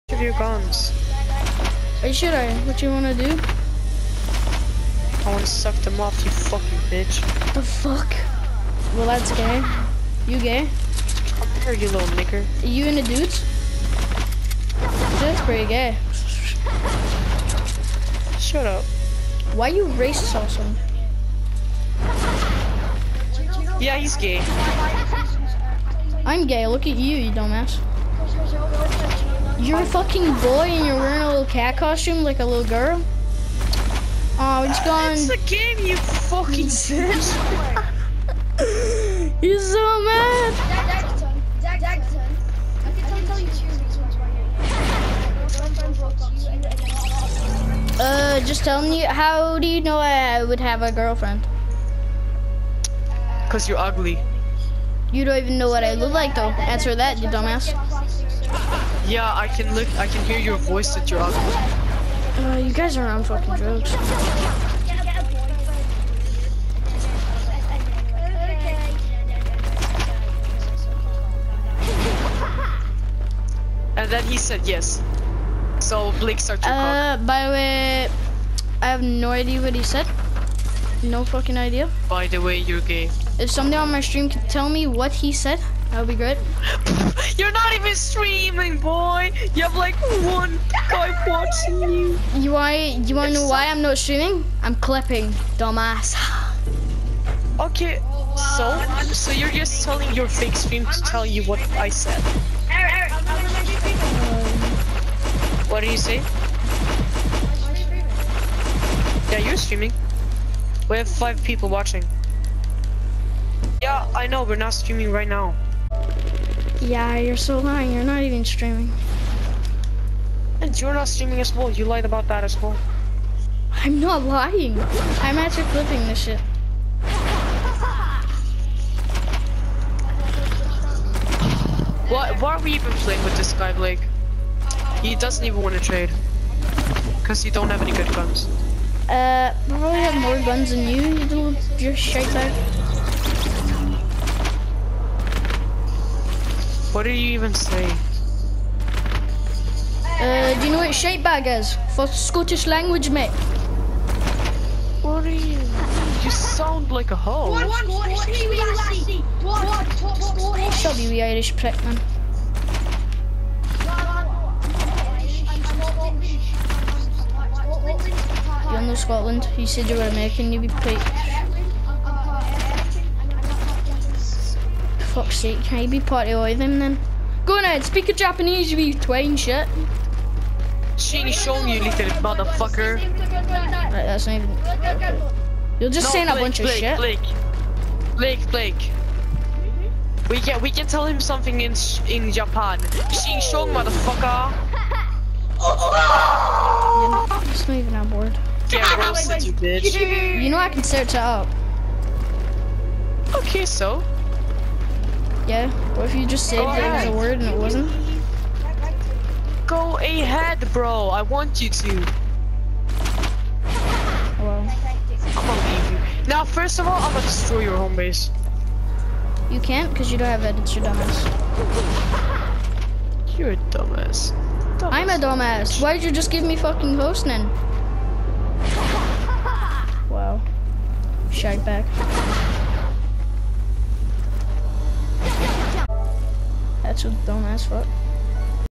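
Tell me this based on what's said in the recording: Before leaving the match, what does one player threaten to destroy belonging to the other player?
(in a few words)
home base.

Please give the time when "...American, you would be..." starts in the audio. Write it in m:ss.
2:50.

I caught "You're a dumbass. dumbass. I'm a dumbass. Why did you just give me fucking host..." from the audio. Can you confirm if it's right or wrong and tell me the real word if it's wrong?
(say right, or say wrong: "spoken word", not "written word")
right.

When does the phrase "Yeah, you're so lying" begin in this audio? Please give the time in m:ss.
1:56.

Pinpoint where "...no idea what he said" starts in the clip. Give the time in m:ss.
1:19.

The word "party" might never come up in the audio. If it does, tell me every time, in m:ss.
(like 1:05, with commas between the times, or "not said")
2:55.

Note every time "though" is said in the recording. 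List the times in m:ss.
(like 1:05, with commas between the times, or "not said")
0:56.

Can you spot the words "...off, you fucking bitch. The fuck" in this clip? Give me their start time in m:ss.
0:05.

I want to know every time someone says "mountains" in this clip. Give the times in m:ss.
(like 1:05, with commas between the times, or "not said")
not said.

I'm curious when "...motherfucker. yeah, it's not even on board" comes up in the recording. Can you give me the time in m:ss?
3:13.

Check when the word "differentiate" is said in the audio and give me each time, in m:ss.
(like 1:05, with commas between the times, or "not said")
not said.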